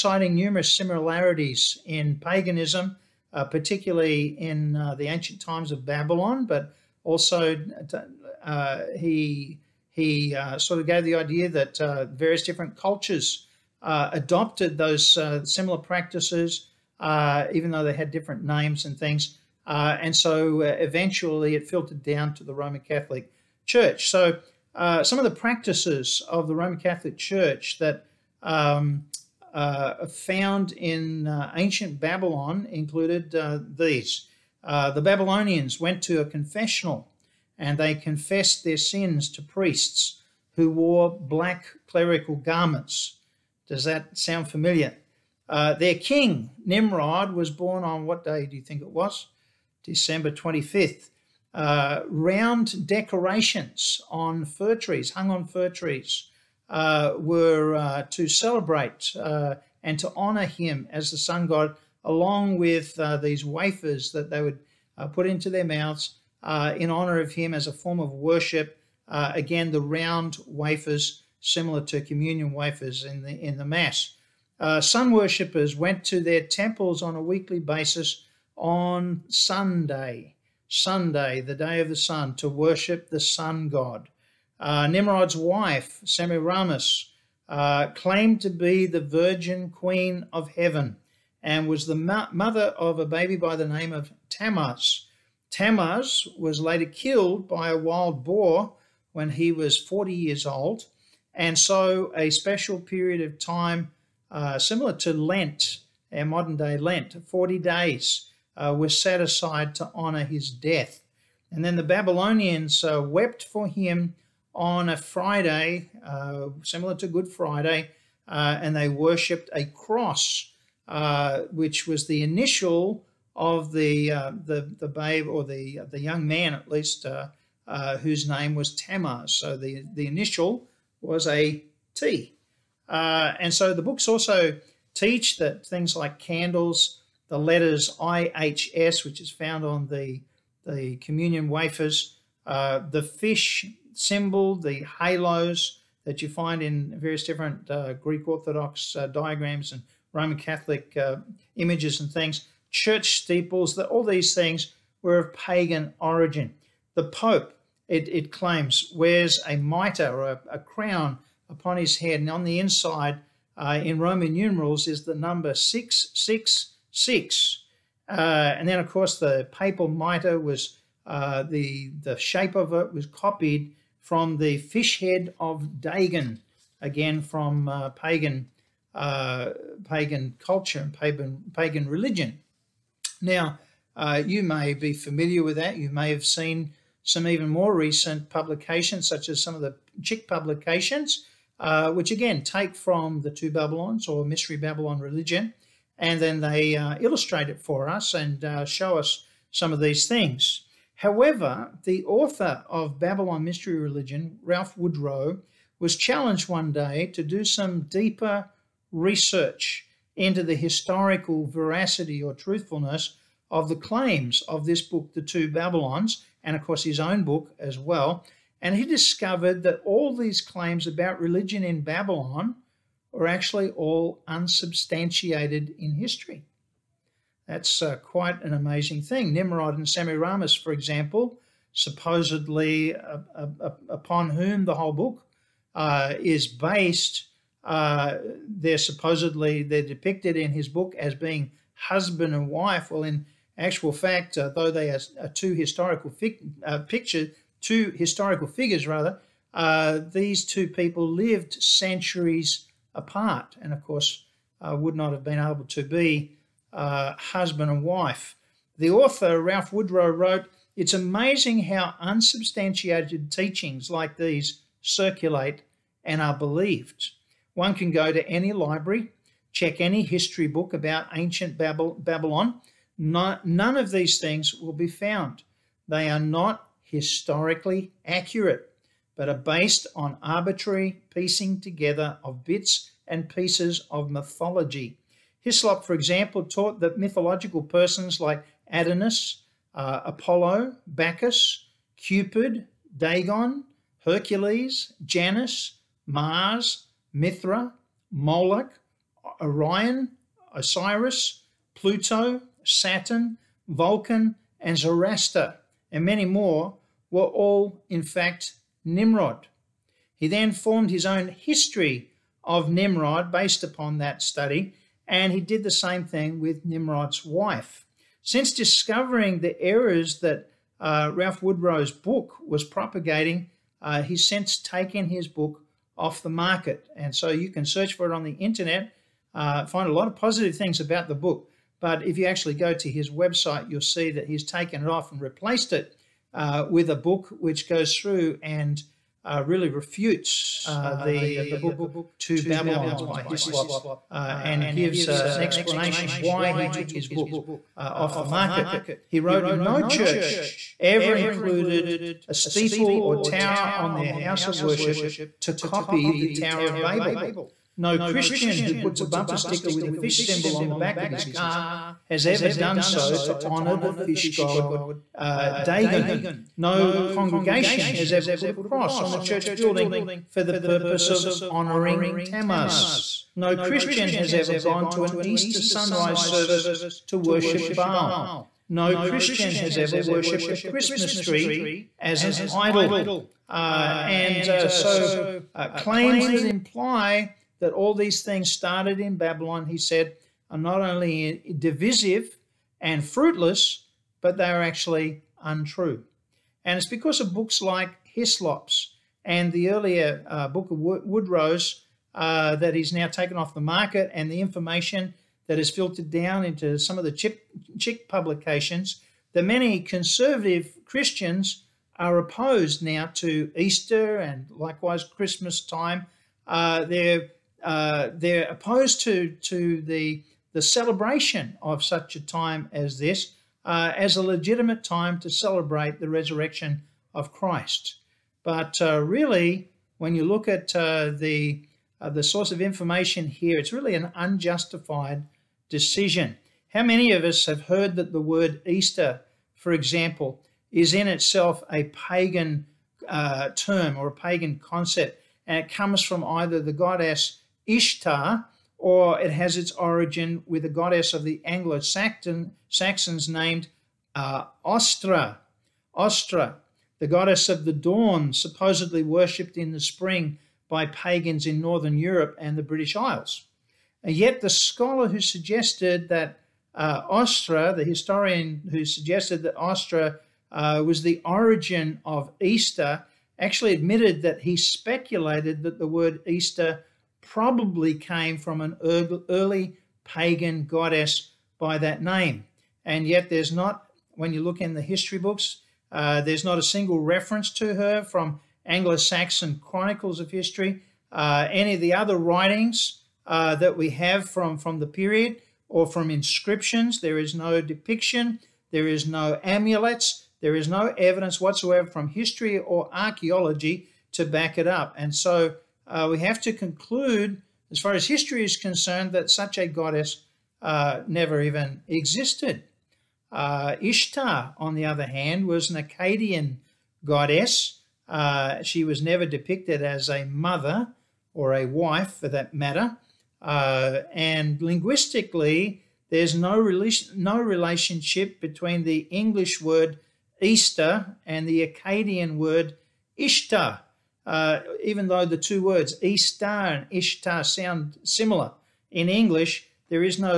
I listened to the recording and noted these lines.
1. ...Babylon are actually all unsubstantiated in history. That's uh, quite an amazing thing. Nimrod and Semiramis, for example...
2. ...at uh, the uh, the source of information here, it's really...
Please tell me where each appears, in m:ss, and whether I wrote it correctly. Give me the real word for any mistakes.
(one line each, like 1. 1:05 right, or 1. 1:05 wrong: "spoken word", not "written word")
1. 3:41 right
2. 7:10 right.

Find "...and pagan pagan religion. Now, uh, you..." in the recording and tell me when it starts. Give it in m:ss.
3:00.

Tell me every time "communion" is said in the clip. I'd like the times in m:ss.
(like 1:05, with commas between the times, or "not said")
1:12, 2:20.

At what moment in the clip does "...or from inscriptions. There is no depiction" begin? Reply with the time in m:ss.
8:15.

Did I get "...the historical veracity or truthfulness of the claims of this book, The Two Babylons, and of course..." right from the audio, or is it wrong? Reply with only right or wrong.
right.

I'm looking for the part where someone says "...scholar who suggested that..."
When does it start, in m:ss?
7:44.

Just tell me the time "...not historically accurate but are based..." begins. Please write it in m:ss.
4:36.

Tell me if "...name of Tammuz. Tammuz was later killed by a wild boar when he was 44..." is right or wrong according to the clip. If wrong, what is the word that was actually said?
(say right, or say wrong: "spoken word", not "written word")
wrong: "40", not "44".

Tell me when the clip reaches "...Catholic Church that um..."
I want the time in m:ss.
0:26.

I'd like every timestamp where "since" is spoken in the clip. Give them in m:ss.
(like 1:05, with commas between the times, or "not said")
5:18, 5:24.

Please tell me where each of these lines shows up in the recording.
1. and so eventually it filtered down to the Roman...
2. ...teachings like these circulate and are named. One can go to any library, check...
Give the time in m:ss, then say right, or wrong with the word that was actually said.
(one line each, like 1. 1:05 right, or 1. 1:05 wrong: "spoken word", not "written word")
1. 0:19 right
2. 4:23 wrong: "believed", not "named".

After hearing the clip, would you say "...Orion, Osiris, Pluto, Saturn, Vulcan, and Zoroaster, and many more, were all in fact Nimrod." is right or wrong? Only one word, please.
right.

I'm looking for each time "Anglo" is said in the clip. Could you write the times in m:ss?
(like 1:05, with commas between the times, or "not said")
7:31, 8:08.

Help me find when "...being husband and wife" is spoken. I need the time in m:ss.
4:01.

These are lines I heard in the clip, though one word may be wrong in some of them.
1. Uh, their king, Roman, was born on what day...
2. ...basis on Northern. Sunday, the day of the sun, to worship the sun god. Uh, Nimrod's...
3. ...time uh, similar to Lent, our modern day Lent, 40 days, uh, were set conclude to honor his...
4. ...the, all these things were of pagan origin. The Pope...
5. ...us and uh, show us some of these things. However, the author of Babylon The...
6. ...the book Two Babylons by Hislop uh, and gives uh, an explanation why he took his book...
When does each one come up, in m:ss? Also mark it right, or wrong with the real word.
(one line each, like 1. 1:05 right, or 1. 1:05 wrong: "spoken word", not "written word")
1. 0:45 wrong: "Nimrod", not "Roman"
2. 1:17 wrong: "Sunday", not "Northern"
3. 1:43 wrong: "aside", not "conclude"
4. 2:33 right
5. 3:17 wrong: "Mystery", not "The"
6. 5:41 right.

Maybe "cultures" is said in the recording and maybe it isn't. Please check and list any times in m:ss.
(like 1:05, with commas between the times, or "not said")
0:12, 3:00.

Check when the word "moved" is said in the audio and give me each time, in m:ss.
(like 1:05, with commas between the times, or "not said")
not said.